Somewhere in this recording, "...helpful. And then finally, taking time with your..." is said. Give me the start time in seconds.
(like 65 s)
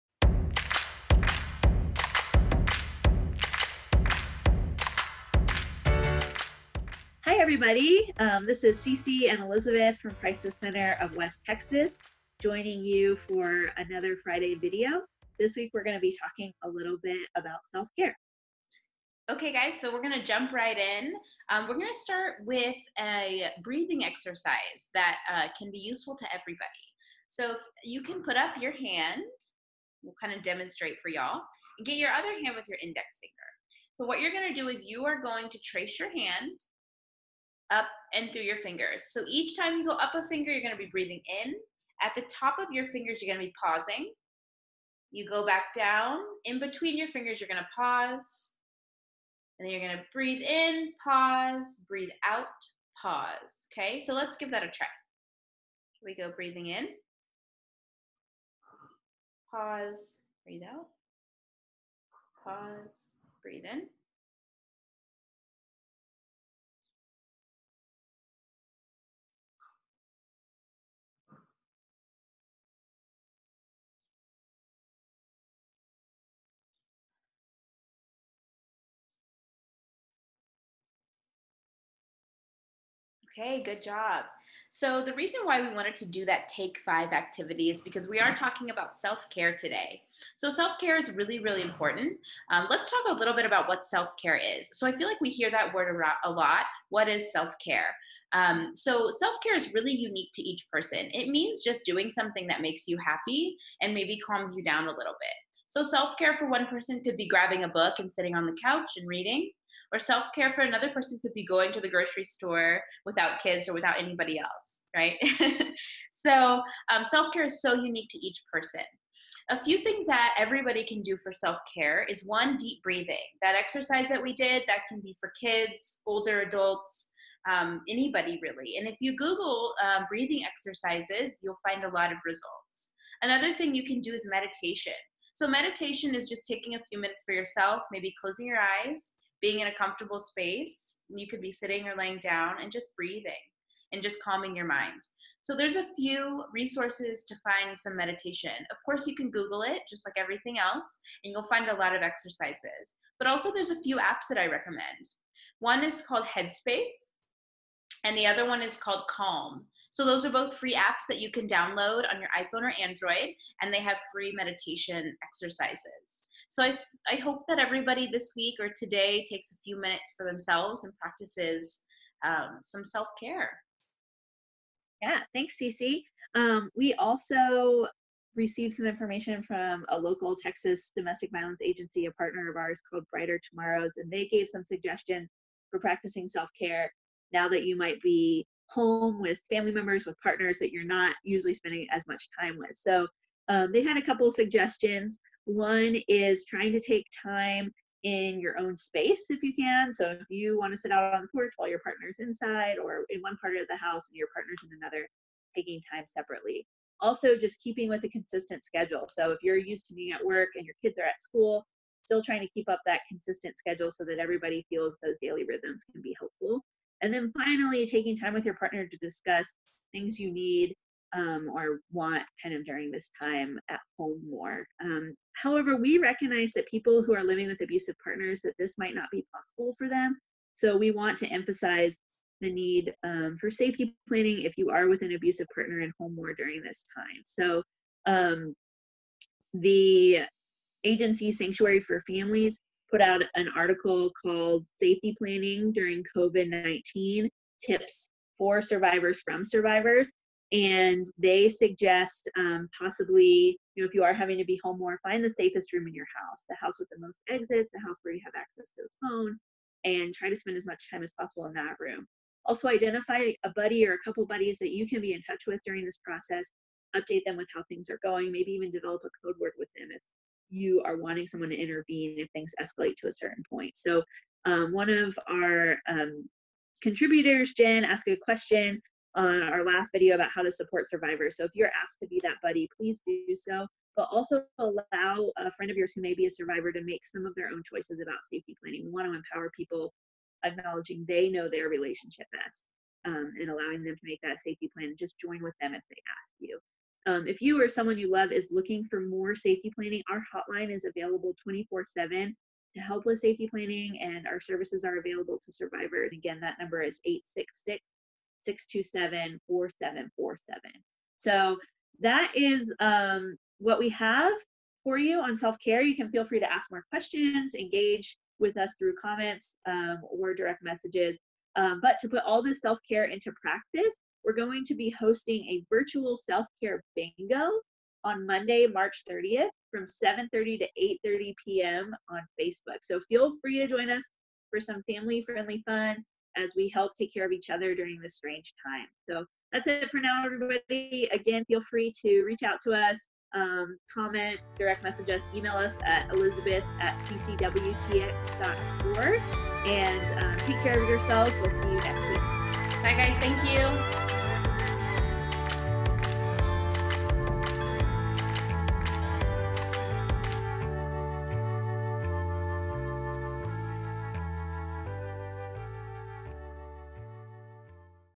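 216 s.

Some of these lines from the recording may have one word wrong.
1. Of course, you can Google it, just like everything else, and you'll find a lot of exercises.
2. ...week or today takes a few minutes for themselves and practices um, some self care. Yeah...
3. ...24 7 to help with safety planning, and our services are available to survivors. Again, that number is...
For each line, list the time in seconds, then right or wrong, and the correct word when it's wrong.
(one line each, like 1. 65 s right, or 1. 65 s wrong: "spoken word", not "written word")
1. 148 s right
2. 168 s right
3. 301 s right.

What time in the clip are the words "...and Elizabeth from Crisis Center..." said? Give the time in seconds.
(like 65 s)
9 s.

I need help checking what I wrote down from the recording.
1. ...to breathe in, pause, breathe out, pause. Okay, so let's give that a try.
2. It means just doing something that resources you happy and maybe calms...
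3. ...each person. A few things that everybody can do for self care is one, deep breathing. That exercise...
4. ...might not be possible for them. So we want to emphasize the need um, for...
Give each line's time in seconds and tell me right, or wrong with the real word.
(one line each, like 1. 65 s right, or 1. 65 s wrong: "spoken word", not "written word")
1. 49 s right
2. 101 s wrong: "makes", not "resources"
3. 118 s right
4. 228 s right.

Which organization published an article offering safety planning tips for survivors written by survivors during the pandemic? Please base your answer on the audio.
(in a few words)
Sanctuary for Families.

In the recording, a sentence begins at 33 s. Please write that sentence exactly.
So what you're going to do is you are going to trace your hand up and through your fingers.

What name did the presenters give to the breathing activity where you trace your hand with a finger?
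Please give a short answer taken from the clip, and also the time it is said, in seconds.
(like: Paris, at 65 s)
take five, at 86 s.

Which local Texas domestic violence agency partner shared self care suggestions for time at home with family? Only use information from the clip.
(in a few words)
Brighter Tomorrows.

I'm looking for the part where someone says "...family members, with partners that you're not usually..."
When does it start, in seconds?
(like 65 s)
189 s.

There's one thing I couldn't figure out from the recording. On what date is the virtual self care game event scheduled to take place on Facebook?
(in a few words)
March 30th.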